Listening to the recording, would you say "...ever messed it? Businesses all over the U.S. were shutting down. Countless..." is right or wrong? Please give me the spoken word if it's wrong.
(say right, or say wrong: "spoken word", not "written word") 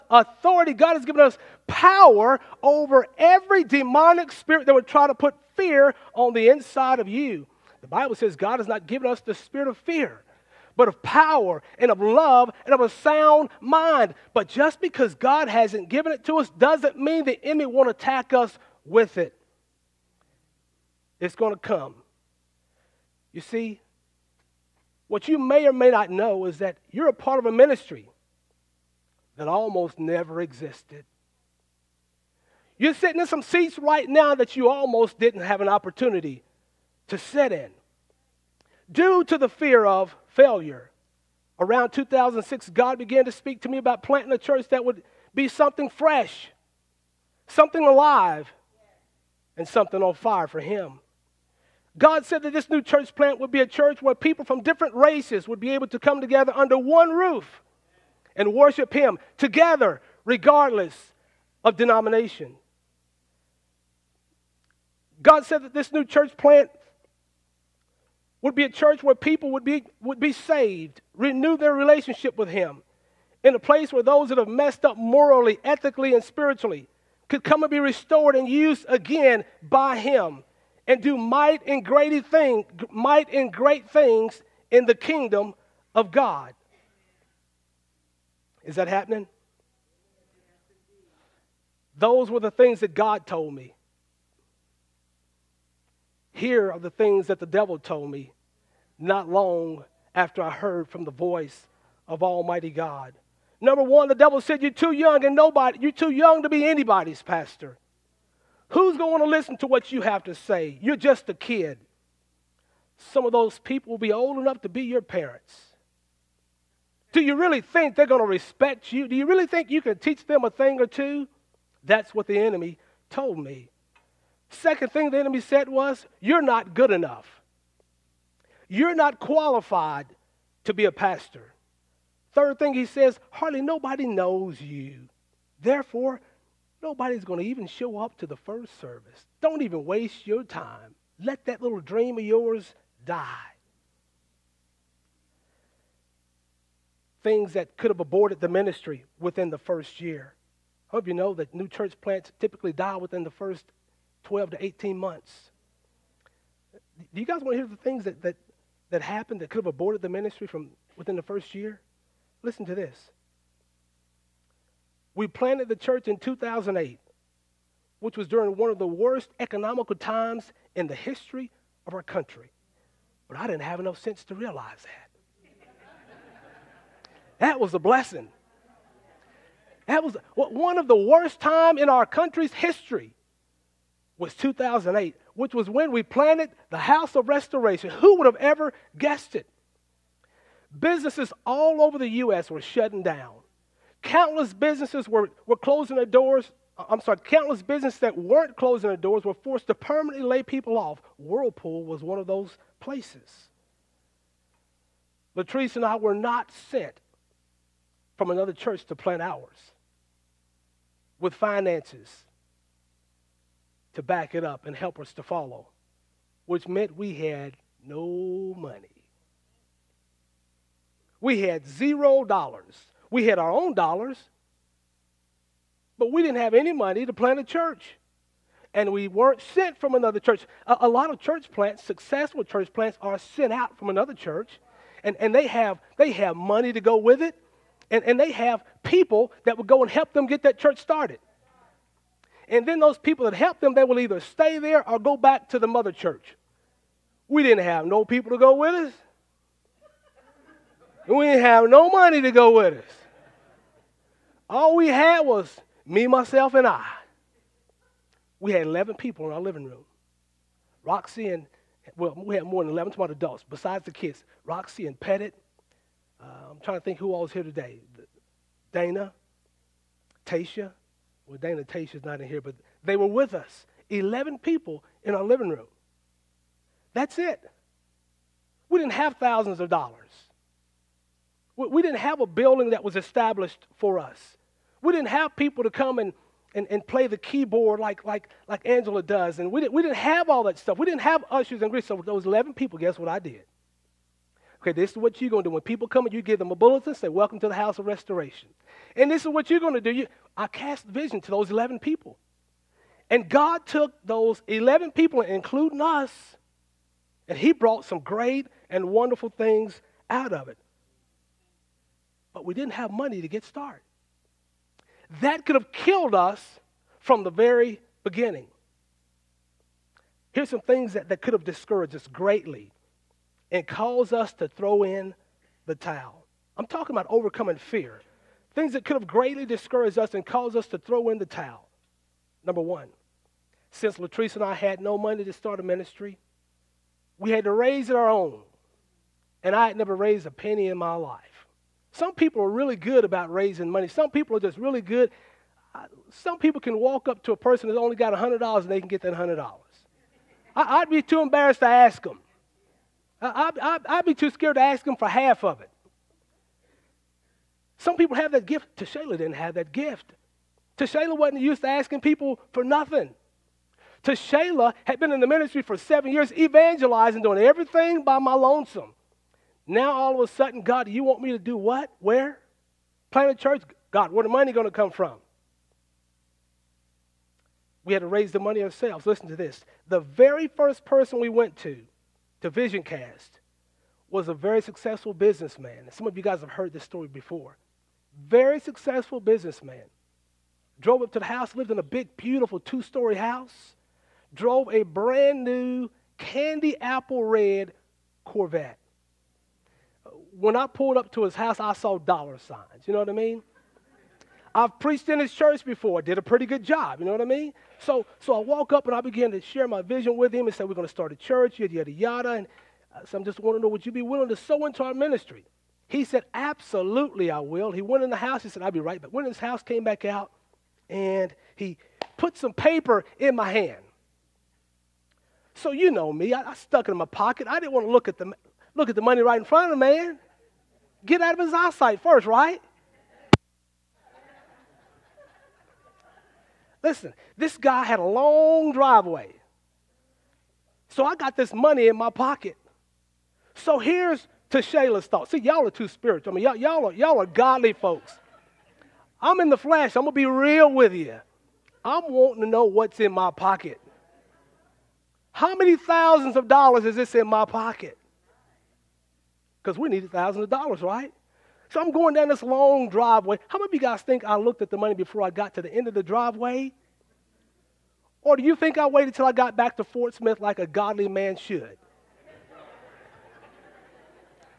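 wrong: "guessed", not "messed".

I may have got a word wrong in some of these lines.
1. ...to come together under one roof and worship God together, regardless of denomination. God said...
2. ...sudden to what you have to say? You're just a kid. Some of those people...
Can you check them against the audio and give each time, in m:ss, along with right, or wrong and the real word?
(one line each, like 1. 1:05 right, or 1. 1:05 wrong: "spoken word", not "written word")
1. 0:55 wrong: "Him", not "God"
2. 1:49 wrong: "listen", not "sudden".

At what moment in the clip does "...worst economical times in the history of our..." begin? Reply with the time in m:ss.
2:48.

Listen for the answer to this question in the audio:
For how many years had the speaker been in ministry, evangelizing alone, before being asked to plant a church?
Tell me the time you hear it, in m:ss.
6:05.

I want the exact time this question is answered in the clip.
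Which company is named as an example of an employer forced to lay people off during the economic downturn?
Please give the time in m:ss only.
3:21.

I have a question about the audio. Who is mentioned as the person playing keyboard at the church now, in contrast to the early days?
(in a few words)
Angela.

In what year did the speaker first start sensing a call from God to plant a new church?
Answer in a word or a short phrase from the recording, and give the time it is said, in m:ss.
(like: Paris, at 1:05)
2006, at 0:41.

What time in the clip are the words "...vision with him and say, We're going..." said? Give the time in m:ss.
6:49.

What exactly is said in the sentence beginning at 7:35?
How many thousands of dollars is this in my pocket?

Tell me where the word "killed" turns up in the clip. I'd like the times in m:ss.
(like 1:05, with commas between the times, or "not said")
5:15.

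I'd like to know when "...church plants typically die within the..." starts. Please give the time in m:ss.
2:31.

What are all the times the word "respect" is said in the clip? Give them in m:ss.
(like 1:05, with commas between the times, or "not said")
1:58.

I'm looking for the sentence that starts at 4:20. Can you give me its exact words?
Roxy and, well, we had more than 11 smart adults besides the kids.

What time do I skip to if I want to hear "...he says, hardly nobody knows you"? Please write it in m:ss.
2:12.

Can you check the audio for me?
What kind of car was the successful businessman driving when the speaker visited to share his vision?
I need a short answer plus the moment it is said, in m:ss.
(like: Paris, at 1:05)
Candy apple red Corvette, at 6:36.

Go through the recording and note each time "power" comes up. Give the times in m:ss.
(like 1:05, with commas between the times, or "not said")
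0:01, 0:11.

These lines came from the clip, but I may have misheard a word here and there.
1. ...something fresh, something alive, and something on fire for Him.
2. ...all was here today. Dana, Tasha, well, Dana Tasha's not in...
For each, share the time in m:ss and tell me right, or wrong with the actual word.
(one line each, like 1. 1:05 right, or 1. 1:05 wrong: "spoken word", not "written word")
1. 0:45 right
2. 4:27 right.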